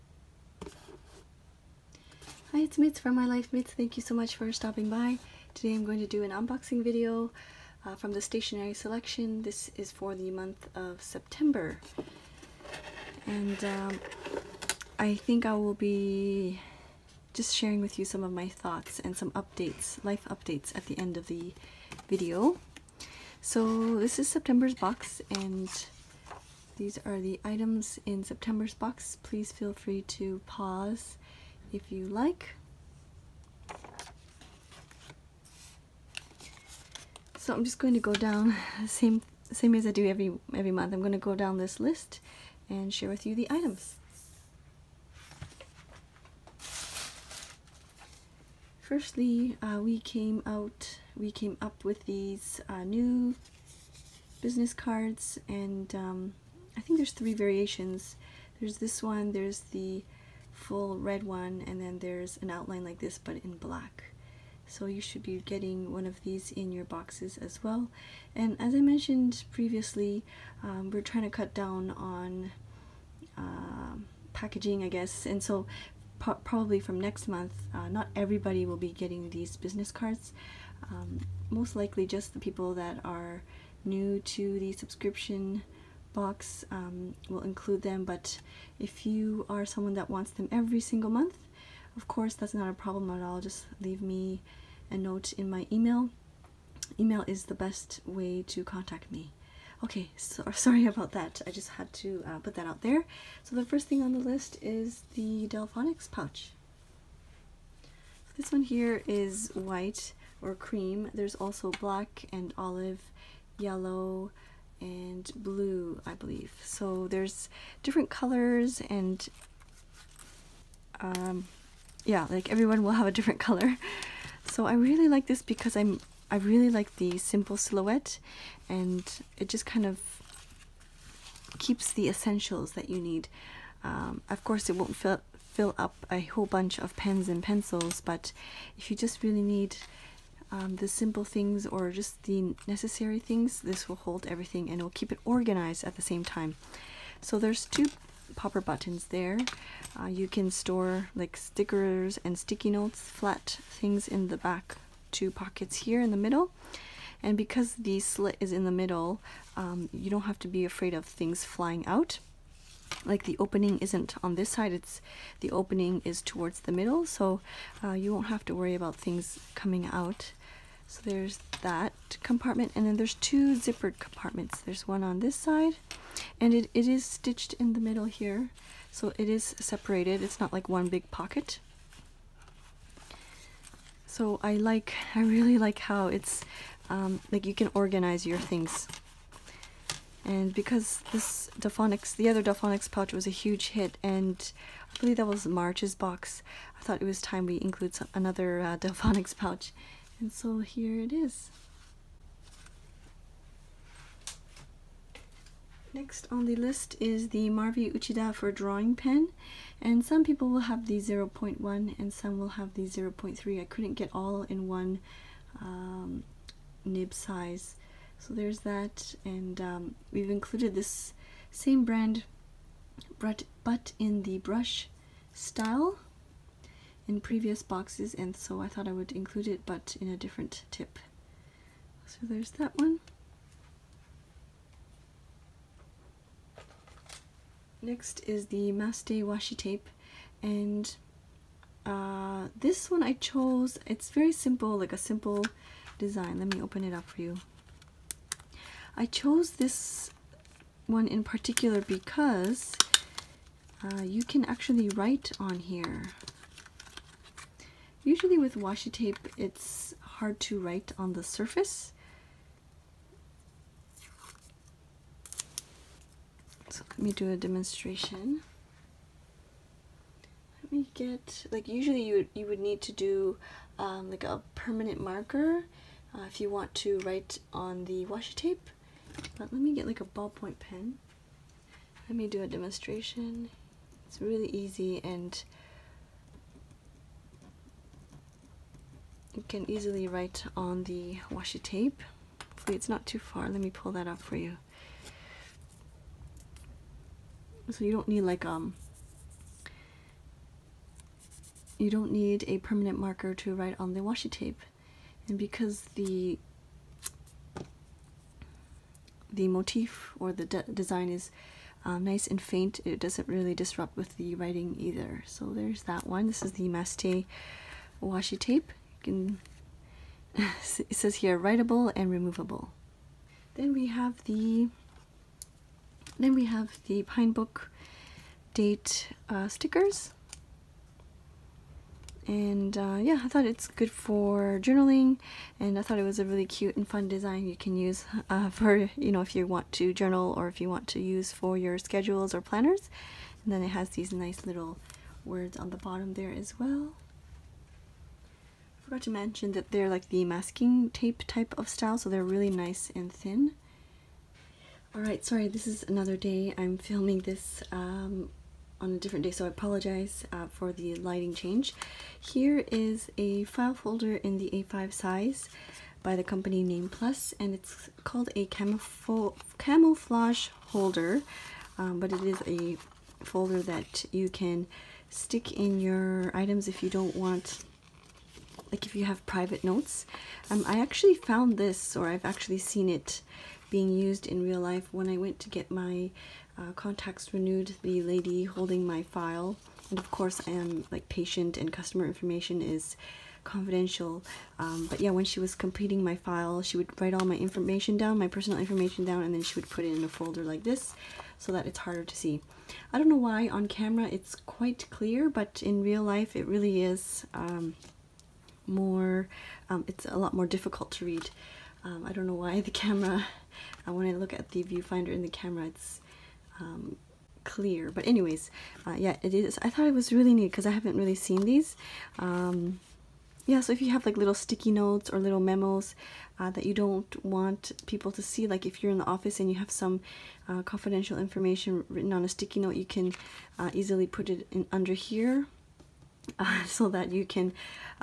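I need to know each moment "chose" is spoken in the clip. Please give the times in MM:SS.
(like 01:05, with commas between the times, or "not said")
04:03, 04:09.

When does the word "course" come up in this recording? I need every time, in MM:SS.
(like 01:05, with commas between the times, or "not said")
01:32, 02:14, 06:30.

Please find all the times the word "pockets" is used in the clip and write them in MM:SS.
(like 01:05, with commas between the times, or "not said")
02:35, 03:01.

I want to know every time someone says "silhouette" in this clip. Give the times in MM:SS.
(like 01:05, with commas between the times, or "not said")
02:07.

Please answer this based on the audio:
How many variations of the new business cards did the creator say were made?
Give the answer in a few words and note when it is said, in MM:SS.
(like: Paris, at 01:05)
3, at 00:56.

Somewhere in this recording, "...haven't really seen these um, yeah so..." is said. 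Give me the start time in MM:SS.
07:00.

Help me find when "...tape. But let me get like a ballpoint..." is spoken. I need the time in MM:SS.
04:38.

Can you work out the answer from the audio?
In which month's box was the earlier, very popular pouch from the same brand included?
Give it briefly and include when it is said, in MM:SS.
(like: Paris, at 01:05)
March, at 03:14.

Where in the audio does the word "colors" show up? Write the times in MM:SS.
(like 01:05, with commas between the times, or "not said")
01:58, 02:03.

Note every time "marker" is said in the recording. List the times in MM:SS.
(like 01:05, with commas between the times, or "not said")
04:34, 05:02.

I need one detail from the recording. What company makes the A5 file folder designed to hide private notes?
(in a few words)
Name Plus.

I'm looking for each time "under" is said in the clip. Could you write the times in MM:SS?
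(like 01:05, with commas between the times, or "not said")
07:14.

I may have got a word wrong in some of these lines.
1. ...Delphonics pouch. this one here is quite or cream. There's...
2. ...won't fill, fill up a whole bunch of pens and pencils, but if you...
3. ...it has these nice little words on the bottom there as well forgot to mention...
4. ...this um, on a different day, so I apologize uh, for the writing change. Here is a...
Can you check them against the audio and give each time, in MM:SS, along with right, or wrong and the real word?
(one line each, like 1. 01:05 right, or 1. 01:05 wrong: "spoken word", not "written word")
1. 01:45 wrong: "white", not "quite"
2. 02:14 right
3. 05:43 right
4. 05:57 wrong: "lighting", not "writing".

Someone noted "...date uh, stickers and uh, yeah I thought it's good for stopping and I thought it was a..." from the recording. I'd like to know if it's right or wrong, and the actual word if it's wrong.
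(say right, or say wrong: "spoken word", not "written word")
wrong: "journaling", not "stopping".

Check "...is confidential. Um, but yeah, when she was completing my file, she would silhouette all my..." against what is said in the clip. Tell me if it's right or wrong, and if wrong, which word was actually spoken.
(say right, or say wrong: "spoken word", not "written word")
wrong: "write", not "silhouette".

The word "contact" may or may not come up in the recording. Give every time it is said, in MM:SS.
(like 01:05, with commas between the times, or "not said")
01:38, 06:26.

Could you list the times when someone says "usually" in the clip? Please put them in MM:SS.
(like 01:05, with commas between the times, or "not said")
04:18, 04:31.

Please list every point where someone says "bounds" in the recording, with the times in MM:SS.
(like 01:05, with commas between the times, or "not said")
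not said.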